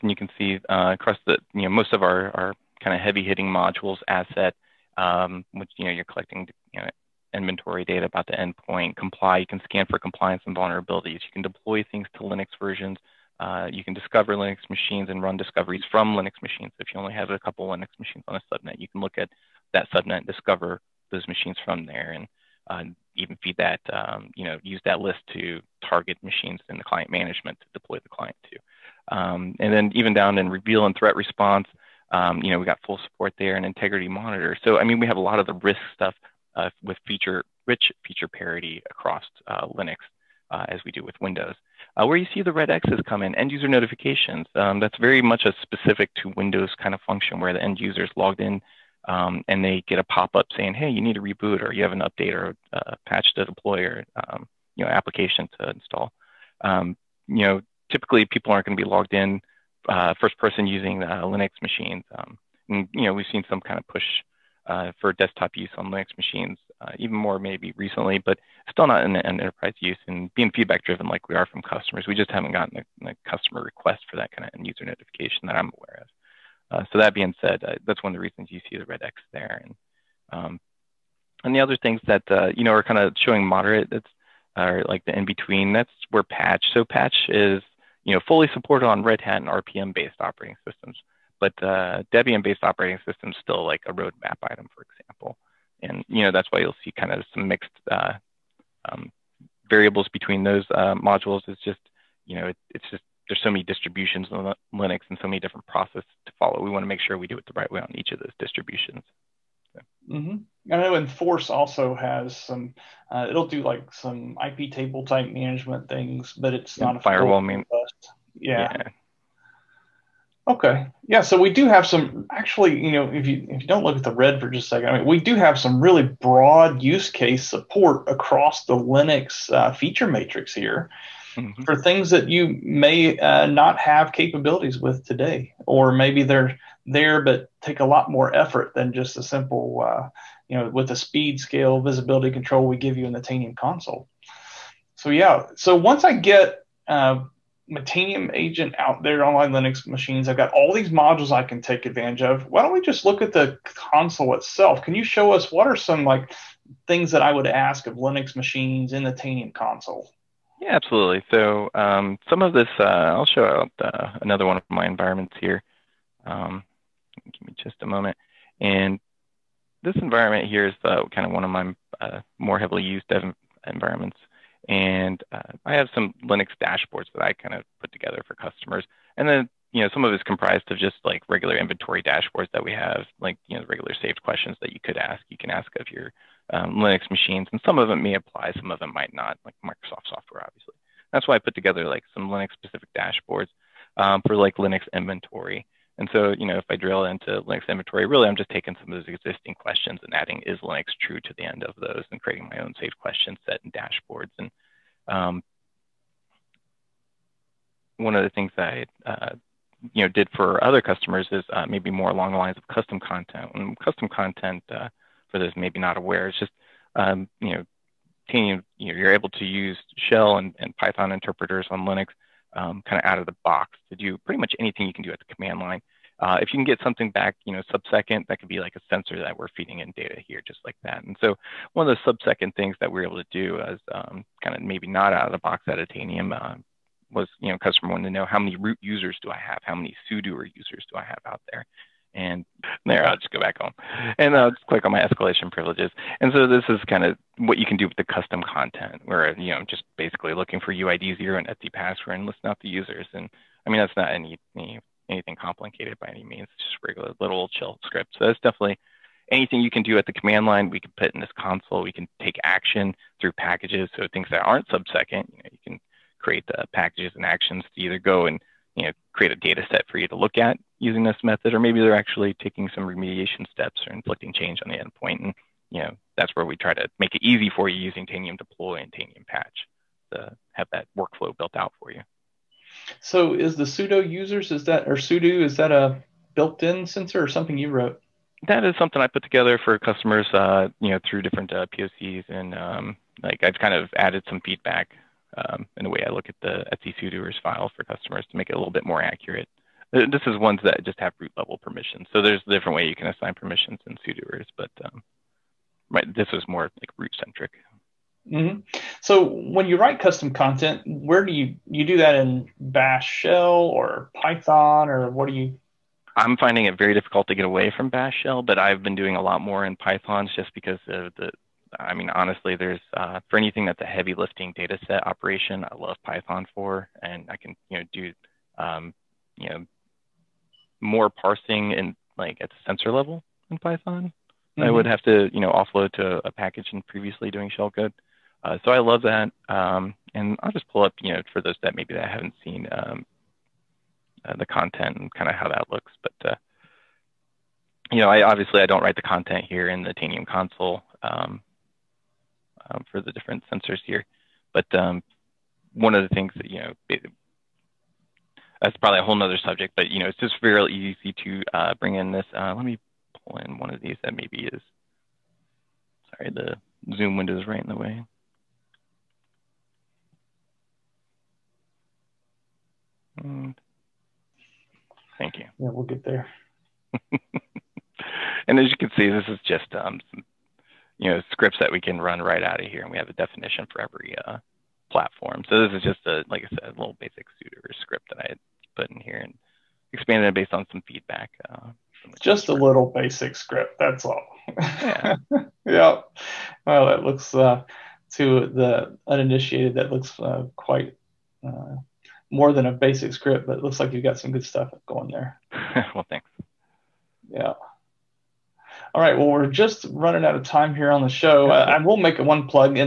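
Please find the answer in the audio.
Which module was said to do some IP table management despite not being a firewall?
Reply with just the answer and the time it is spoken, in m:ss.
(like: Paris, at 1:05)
Enforce, at 1:50.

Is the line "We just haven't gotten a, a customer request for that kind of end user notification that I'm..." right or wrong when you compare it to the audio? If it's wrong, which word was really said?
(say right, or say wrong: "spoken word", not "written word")
right.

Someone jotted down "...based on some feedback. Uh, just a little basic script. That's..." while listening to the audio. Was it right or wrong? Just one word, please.
right.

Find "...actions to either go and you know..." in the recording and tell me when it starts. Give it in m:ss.
4:27.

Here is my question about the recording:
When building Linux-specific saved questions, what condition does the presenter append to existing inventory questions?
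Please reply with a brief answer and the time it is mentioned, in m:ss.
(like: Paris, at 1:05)
is Linux true, at 3:20.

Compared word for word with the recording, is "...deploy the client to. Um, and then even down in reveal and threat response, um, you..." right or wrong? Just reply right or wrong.
right.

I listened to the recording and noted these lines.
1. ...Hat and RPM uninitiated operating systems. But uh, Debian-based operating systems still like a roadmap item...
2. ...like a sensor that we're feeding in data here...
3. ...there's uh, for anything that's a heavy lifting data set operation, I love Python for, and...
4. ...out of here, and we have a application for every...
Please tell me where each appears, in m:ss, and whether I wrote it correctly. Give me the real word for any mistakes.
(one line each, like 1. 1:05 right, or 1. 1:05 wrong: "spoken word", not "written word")
1. 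1:29 wrong: "based", not "uninitiated"
2. 3:48 right
3. 5:22 right
4. 6:22 wrong: "definition", not "application".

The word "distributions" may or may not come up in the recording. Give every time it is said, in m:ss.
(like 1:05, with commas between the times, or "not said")
1:43, 1:48.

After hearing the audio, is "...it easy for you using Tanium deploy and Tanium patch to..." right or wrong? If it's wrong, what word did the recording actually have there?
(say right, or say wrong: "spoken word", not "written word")
right.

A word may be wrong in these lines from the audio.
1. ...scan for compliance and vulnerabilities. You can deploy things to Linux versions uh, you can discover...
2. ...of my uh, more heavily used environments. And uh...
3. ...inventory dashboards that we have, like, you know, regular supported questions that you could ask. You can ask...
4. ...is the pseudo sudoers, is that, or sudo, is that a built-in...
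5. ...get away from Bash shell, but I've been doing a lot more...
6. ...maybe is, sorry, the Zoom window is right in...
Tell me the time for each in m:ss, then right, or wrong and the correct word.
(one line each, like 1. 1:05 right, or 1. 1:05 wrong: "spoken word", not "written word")
1. 0:09 right
2. 2:51 right
3. 3:01 wrong: "saved", not "supported"
4. 4:43 wrong: "users", not "sudoers"
5. 5:17 right
6. 6:04 right.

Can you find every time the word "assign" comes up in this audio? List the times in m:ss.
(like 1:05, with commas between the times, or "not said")
5:03.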